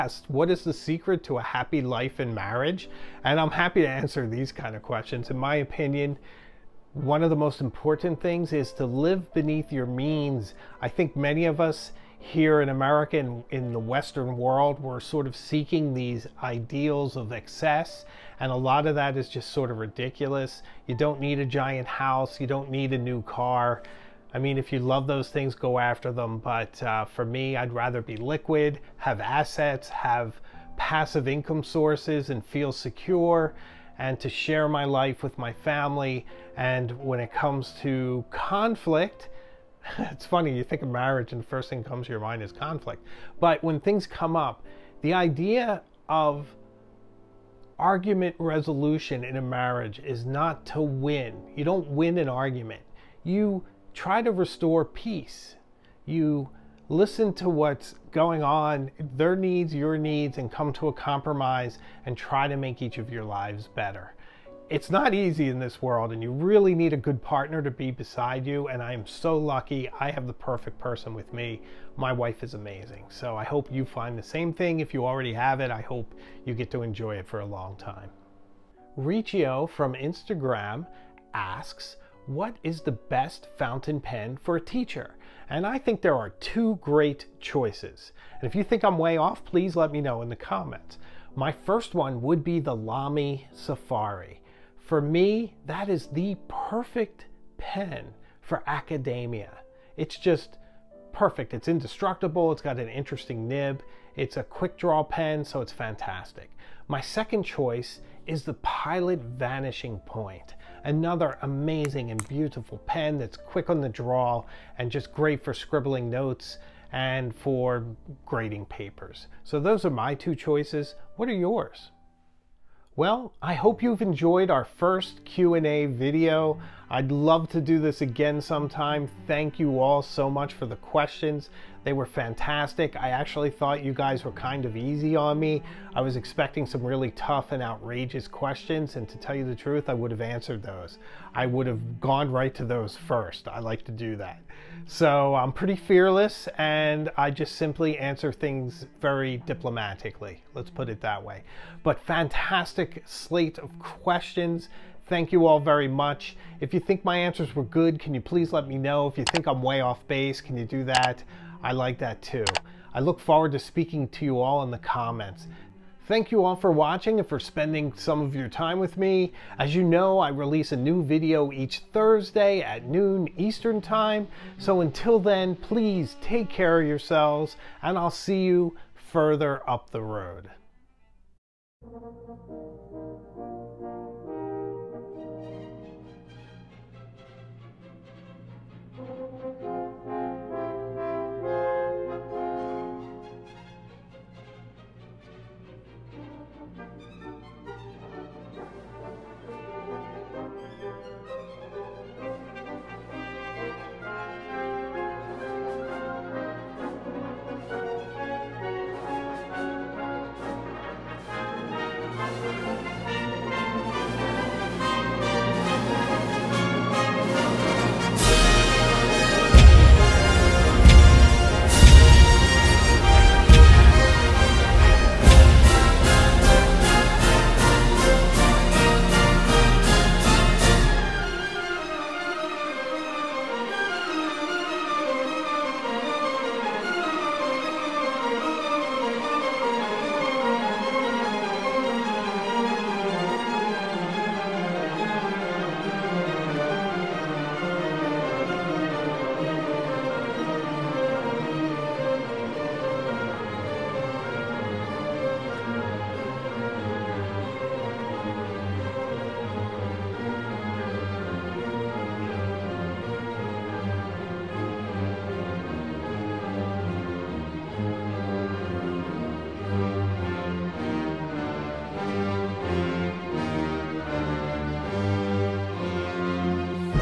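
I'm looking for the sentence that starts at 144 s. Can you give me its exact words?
So I'm pretty fearless, and I just simply answer things very diplomatically.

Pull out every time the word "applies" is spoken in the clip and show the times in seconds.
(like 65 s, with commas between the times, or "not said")
not said.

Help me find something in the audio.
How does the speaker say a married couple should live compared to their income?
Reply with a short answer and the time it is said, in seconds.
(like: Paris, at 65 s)
Beneath your means, at 9 s.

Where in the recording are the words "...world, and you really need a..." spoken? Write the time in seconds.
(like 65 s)
65 s.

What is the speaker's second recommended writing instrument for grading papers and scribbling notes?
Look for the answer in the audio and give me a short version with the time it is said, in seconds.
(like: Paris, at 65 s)
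Pilot Vanishing Point, at 108 s.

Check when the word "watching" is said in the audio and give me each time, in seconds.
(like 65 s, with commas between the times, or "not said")
166 s.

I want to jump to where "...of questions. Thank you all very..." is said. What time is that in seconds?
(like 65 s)
153 s.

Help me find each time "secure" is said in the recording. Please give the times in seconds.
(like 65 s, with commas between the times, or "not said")
32 s.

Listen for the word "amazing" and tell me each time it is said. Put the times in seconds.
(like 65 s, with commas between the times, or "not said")
72 s, 111 s.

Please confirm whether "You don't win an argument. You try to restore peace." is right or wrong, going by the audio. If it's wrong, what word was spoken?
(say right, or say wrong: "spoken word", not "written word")
right.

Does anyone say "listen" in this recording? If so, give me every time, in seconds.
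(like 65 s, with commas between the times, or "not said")
56 s.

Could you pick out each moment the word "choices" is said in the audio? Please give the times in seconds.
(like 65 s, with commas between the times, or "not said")
87 s, 107 s, 120 s.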